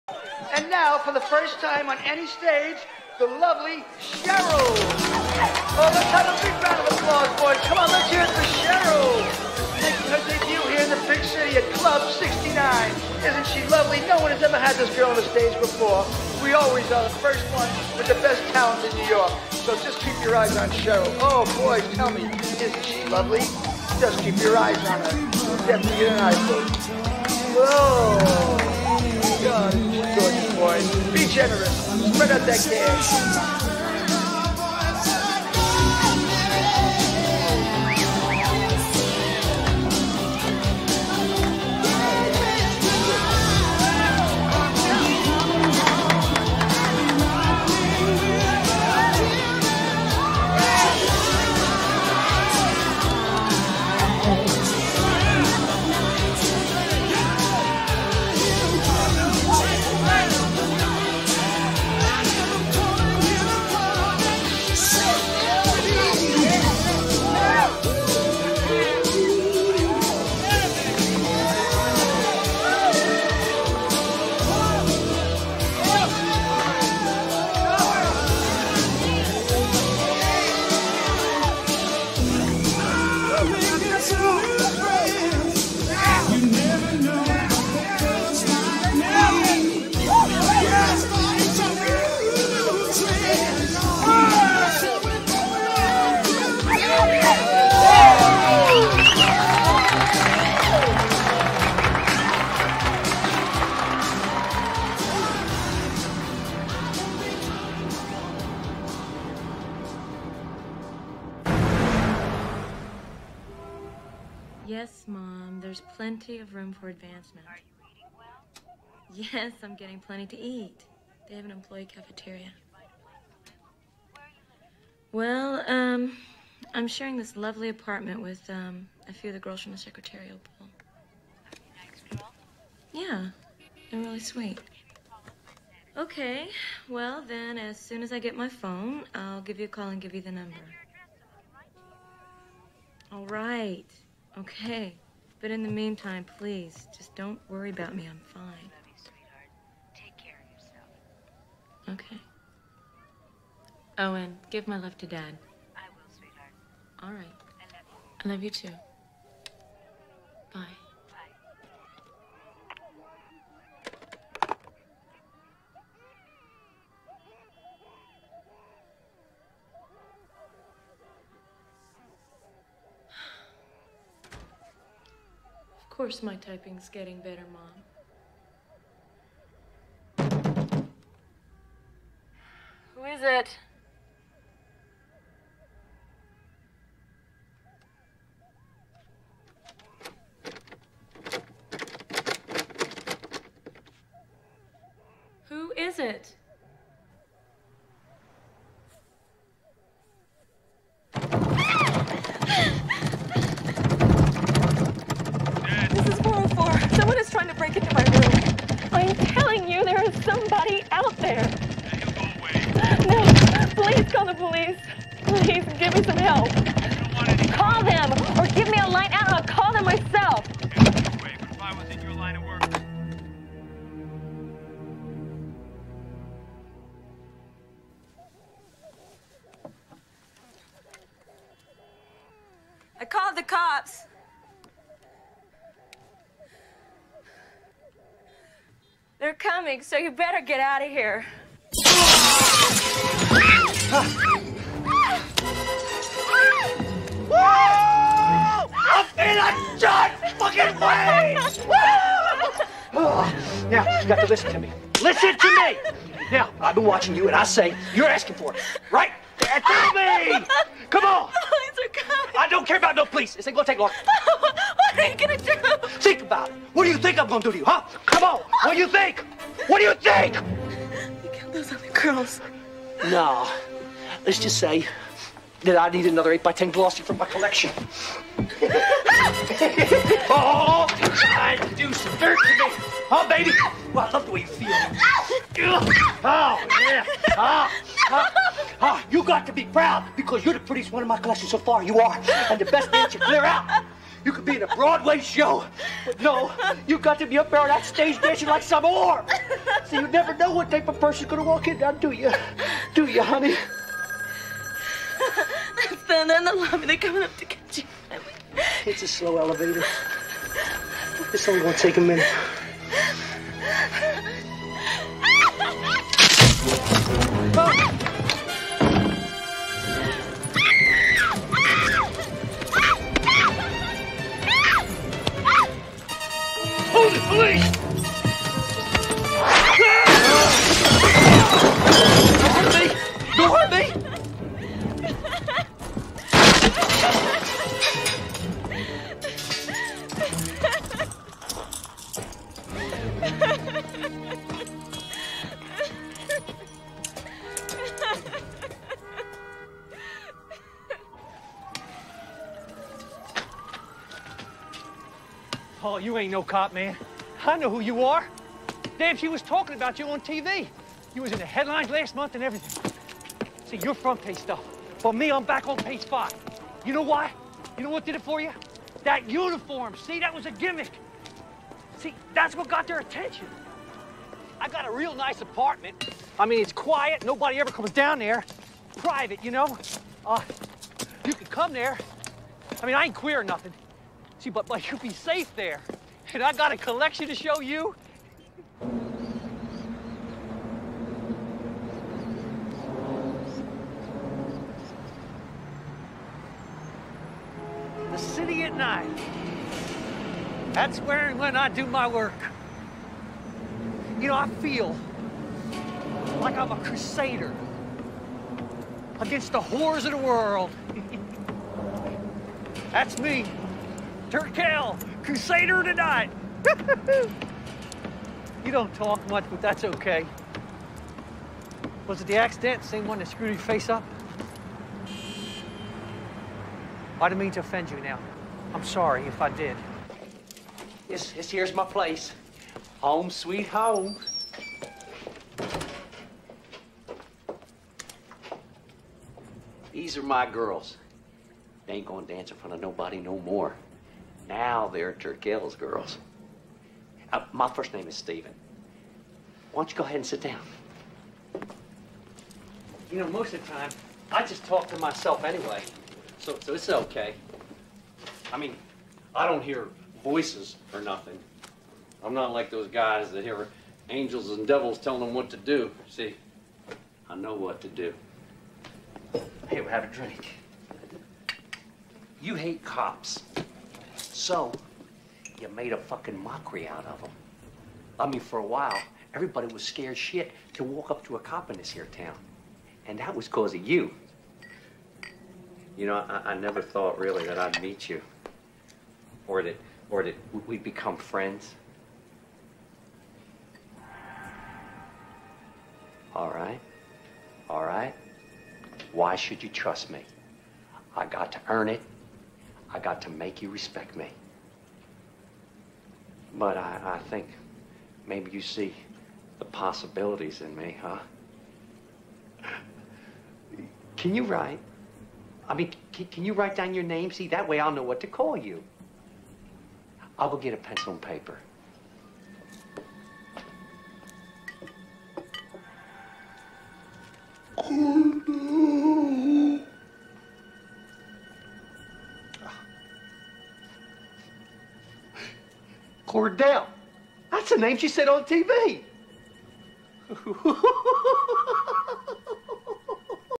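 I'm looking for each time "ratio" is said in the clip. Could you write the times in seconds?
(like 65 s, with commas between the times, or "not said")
not said.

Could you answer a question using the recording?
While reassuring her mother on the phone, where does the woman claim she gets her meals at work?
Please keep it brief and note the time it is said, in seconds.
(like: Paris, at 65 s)
employee cafeteria, at 121 s.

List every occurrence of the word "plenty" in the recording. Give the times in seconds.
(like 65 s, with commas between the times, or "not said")
115 s, 119 s.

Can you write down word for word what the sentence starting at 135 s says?
Okay, well then, as soon as I get my phone, I'll give you a call and give you the number.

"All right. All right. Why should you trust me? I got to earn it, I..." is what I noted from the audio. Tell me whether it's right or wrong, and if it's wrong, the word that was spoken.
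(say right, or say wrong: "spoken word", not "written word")
right.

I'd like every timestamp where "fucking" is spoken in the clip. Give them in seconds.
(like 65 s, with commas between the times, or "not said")
250 s, 475 s.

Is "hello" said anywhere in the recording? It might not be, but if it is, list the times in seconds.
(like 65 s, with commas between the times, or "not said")
not said.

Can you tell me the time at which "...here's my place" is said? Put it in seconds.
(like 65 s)
431 s.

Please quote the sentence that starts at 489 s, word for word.
Or that, or that we'd become friends.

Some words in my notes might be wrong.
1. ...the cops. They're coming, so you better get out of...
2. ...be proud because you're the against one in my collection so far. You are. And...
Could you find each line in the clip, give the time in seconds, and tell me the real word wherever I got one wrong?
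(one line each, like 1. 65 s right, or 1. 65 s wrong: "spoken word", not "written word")
1. 233 s right
2. 289 s wrong: "prettiest", not "against".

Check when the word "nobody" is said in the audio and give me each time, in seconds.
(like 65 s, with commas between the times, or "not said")
377 s, 442 s.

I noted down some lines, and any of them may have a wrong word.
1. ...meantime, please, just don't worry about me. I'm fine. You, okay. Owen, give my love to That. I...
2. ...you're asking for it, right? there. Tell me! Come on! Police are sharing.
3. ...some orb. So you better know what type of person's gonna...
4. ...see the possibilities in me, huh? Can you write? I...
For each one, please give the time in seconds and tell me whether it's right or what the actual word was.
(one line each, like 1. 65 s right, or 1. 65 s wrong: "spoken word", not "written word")
1. 145 s wrong: "Dad", not "That"
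2. 257 s wrong: "coming", not "sharing"
3. 298 s wrong: "never", not "better"
4. 508 s right.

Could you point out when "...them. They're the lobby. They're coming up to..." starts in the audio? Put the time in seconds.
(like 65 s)
306 s.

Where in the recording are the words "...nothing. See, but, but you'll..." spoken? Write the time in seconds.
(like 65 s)
383 s.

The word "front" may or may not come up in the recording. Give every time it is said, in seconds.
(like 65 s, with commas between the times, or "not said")
363 s, 442 s.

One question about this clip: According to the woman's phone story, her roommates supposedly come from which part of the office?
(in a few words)
secretarial pool.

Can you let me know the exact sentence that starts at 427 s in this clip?
I didn't mean to offend you now.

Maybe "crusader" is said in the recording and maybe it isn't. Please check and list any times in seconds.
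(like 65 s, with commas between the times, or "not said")
406 s, 415 s.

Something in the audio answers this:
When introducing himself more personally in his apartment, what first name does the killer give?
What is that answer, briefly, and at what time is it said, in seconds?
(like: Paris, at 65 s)
Steven, at 448 s.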